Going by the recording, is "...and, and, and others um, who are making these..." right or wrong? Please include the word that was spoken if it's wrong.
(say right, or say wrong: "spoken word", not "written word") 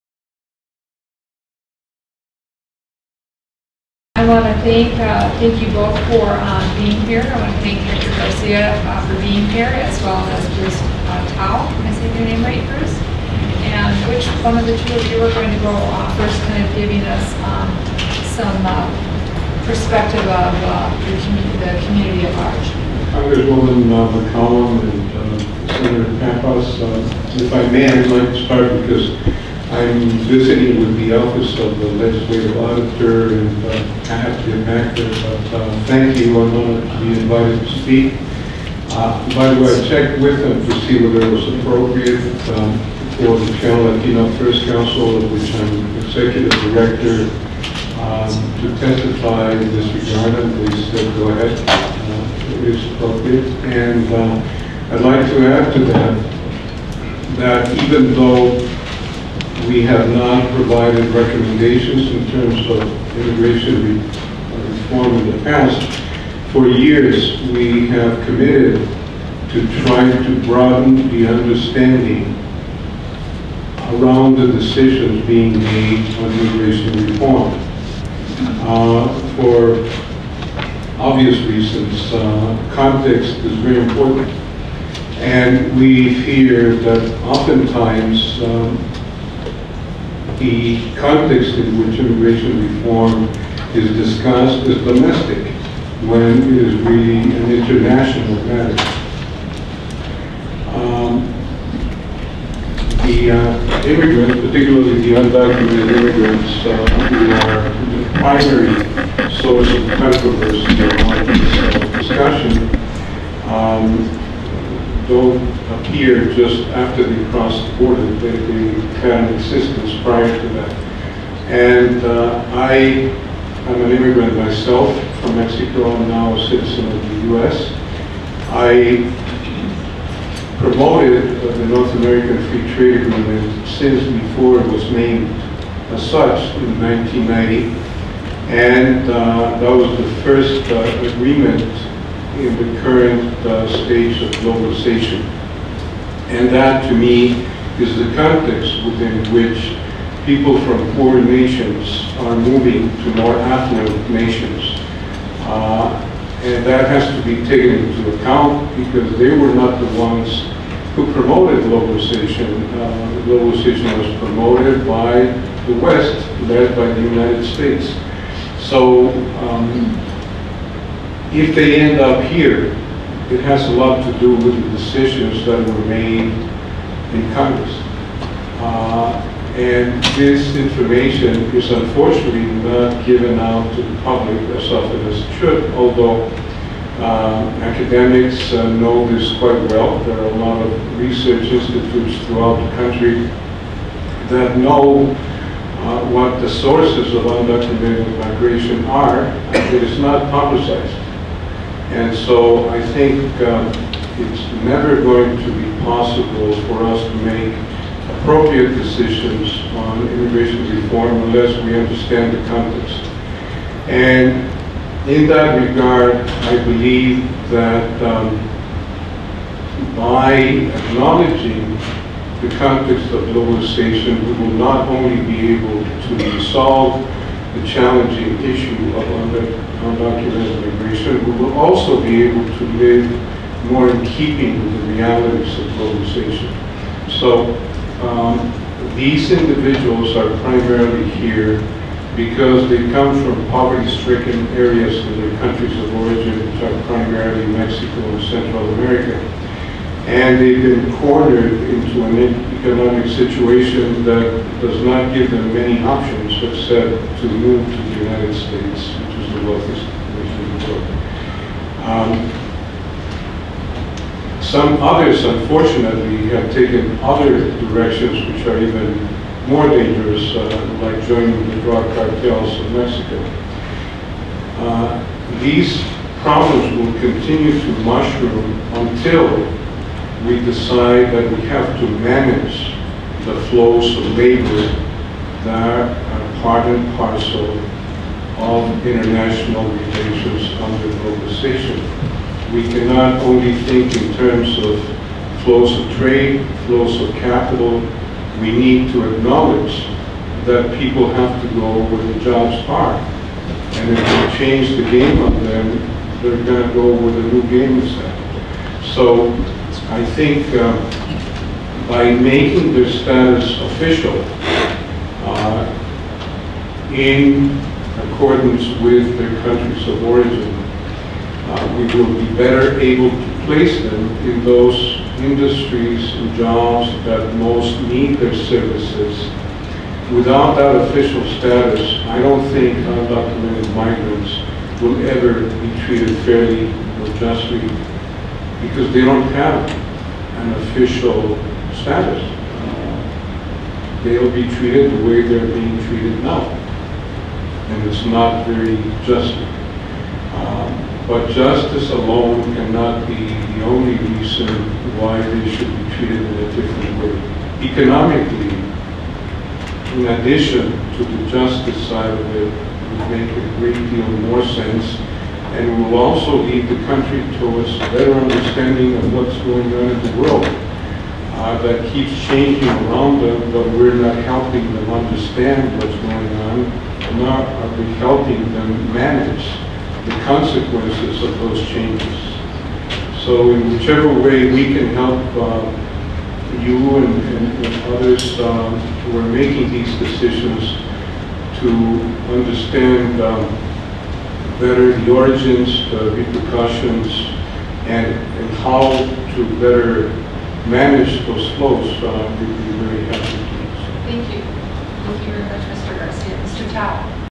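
right.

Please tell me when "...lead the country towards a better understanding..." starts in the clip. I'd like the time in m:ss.
6:06.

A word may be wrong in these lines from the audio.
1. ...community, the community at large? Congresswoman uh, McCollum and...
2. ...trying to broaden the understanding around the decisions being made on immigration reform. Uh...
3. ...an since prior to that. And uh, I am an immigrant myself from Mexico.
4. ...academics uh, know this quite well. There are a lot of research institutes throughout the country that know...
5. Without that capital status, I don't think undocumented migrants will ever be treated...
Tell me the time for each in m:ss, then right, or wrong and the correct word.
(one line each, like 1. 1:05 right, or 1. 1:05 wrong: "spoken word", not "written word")
1. 0:21 right
2. 1:09 right
3. 1:59 wrong: "existence", not "since"
4. 3:07 right
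5. 5:30 wrong: "official", not "capital".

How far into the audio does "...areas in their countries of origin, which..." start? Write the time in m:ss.
4:04.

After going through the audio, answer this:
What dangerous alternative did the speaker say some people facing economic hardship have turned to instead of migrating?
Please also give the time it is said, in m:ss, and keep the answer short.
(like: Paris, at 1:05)
drug cartels, at 4:31.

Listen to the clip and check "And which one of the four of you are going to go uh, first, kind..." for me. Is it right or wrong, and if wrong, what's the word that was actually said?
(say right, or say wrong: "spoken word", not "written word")
wrong: "two", not "four".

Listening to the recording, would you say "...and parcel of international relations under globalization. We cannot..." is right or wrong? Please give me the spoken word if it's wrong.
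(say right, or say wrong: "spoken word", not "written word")
right.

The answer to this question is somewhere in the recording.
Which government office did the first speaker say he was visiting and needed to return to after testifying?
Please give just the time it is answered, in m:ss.
0:31.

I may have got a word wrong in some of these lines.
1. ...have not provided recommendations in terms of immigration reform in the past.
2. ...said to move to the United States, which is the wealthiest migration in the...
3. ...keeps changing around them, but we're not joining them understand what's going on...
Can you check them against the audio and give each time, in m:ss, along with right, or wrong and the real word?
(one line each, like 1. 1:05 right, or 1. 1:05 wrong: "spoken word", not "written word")
1. 0:59 right
2. 4:16 wrong: "nation", not "migration"
3. 6:11 wrong: "helping", not "joining".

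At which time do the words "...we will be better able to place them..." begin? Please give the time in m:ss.
5:21.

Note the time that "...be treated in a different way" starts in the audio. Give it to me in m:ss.
5:55.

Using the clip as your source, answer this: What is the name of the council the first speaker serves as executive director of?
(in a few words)
Chicano Latino Affairs Council.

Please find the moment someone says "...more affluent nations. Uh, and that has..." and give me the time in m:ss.
2:33.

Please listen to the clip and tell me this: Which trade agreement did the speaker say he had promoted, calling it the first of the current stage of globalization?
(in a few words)
North American Free Trade Agreement.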